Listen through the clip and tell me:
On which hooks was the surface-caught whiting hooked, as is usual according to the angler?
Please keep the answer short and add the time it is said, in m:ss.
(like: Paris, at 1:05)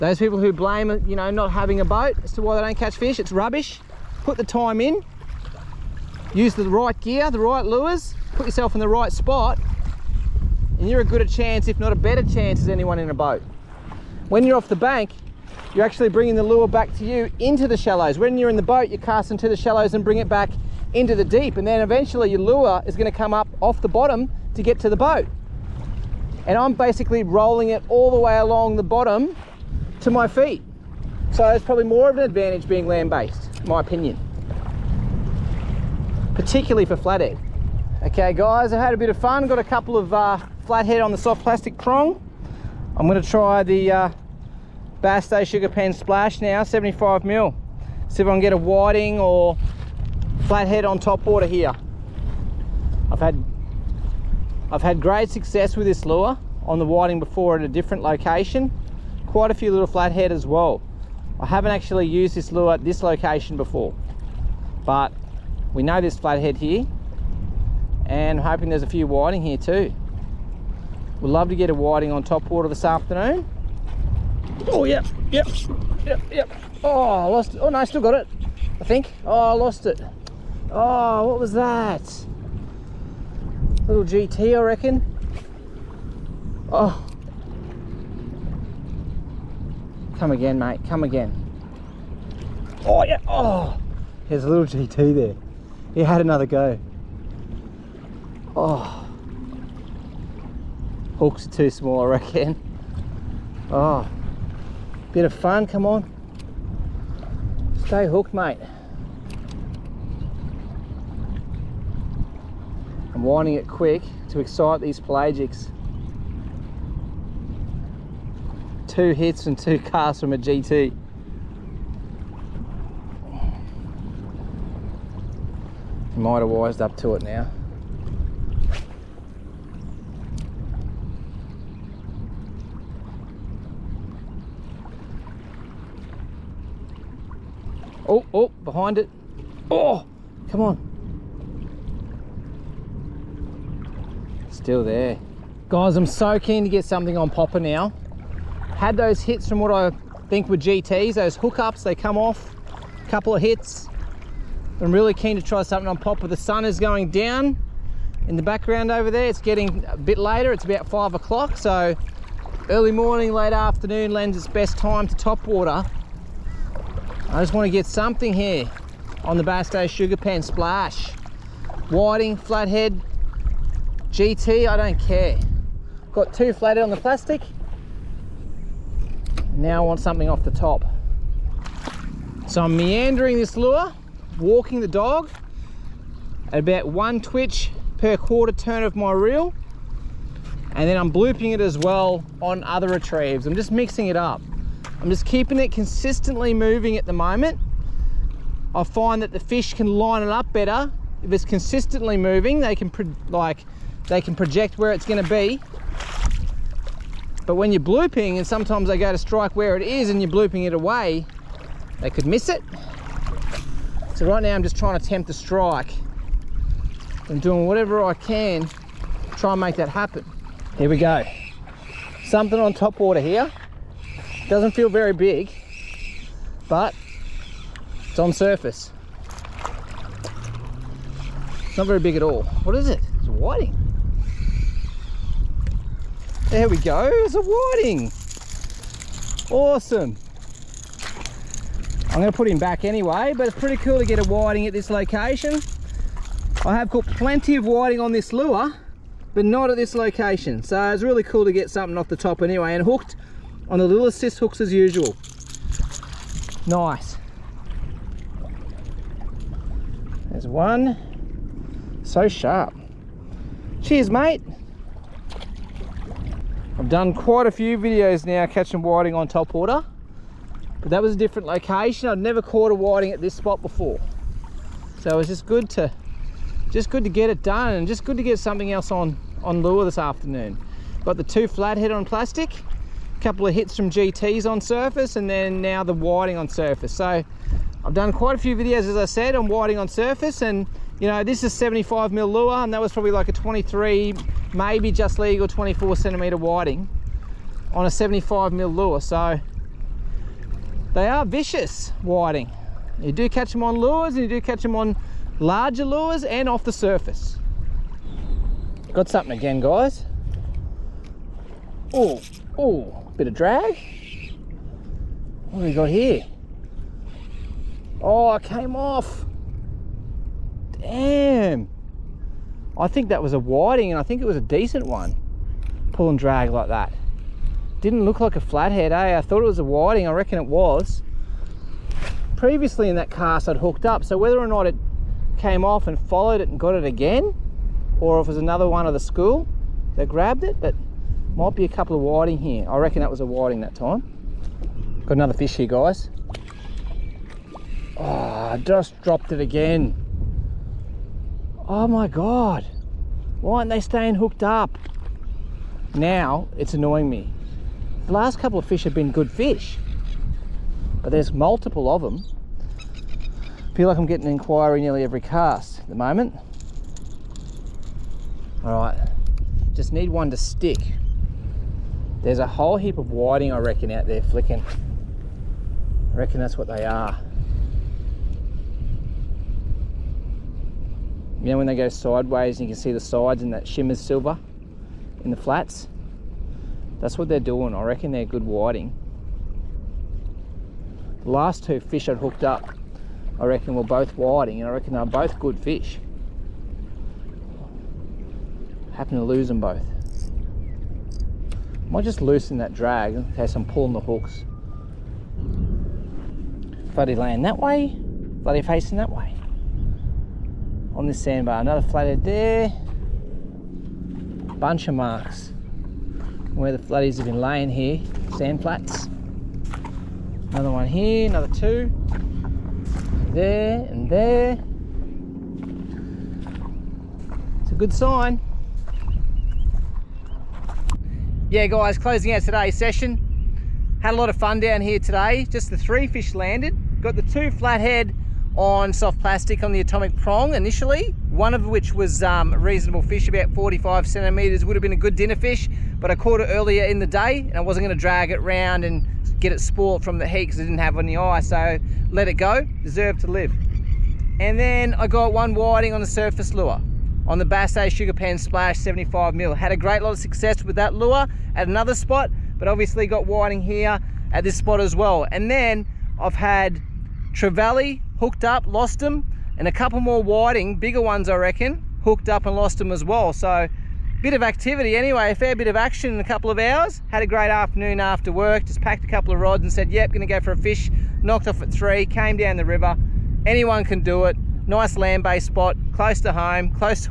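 assist hooks, at 4:13.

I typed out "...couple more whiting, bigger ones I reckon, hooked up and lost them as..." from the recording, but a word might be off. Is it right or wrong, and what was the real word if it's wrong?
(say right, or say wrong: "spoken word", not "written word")
right.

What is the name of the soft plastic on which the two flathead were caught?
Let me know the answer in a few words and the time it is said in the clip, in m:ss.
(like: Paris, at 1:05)
Atomic Prong, at 7:19.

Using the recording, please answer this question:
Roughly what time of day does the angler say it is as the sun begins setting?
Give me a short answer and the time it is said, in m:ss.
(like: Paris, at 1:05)
5 o'clock, at 2:40.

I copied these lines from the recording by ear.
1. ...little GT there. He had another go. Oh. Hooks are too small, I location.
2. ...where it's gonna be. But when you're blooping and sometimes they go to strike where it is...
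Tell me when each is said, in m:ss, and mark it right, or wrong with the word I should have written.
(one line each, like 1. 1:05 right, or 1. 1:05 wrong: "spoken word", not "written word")
1. 1:34 wrong: "reckon", not "location"
2. 3:24 right.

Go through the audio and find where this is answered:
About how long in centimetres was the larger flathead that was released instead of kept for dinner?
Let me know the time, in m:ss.
7:23.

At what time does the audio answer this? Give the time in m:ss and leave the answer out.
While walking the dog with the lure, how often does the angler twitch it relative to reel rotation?
3:06.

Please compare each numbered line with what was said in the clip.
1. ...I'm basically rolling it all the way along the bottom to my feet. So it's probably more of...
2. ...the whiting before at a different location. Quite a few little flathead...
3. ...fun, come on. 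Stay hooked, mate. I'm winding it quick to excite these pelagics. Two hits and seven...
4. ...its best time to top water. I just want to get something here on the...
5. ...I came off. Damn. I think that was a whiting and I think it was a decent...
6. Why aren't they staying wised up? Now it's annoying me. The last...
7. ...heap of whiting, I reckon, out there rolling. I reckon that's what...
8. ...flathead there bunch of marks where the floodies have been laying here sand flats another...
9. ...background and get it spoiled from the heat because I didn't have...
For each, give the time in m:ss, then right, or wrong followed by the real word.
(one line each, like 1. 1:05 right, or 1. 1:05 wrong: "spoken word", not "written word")
1. 0:26 right
2. 0:56 right
3. 1:45 wrong: "two", not "seven"
4. 2:44 right
5. 5:18 right
6. 5:53 wrong: "hooked", not "wised"
7. 6:12 wrong: "flicking", not "rolling"
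8. 6:51 right
9. 7:28 wrong: "round", not "background".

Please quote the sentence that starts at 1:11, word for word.
We'd love to get a whiting on top water this afternoon Oh, yeah, yep, yep, yep.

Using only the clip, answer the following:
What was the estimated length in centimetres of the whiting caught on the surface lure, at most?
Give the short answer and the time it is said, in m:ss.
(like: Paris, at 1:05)
24, at 4:55.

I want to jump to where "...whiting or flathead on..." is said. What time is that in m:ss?
0:48.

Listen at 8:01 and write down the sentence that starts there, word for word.
Knocked off at three, came down the river.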